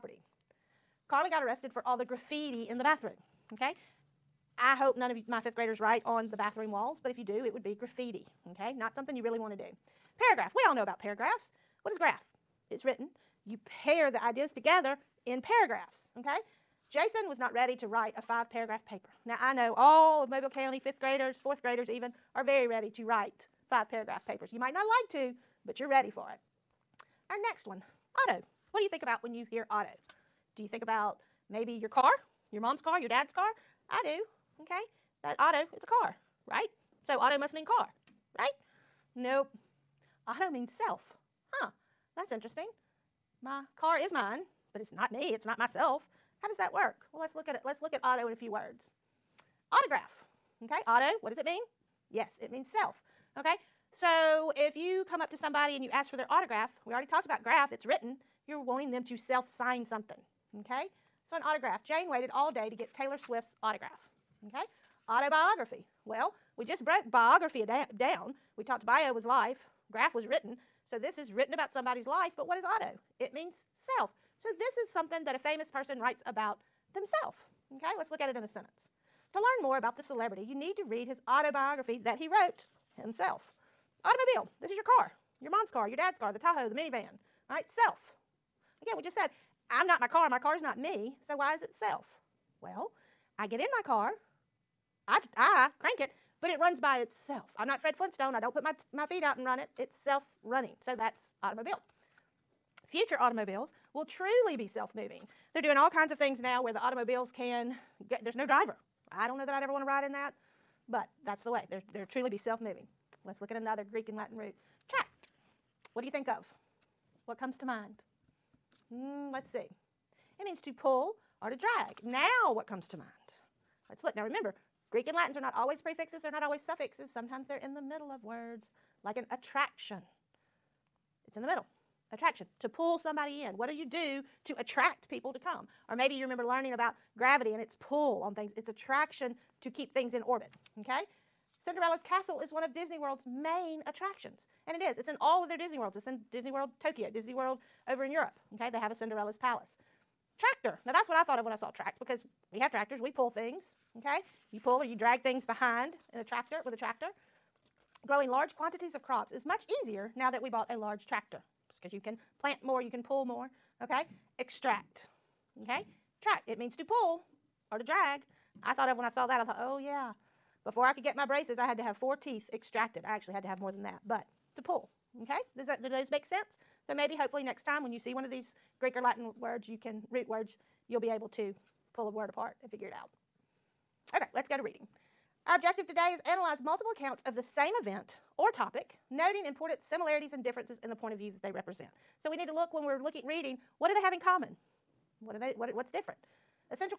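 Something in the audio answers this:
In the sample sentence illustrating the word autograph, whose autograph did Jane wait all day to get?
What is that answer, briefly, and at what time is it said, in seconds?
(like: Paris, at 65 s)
Taylor Swift, at 62 s.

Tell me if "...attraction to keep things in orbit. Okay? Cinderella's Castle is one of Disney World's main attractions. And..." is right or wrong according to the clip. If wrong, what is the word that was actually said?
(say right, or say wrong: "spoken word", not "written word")
right.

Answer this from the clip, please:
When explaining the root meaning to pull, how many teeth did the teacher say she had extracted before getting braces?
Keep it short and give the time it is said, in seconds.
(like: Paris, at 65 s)
4, at 171 s.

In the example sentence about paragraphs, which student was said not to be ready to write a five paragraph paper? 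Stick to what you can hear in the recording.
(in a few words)
Jason.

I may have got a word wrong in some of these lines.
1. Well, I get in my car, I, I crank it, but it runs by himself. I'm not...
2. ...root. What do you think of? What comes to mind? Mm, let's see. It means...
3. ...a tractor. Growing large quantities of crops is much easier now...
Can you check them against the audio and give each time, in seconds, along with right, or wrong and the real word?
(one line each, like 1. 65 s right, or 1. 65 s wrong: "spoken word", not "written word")
1. 92 s wrong: "itself", not "himself"
2. 114 s right
3. 156 s right.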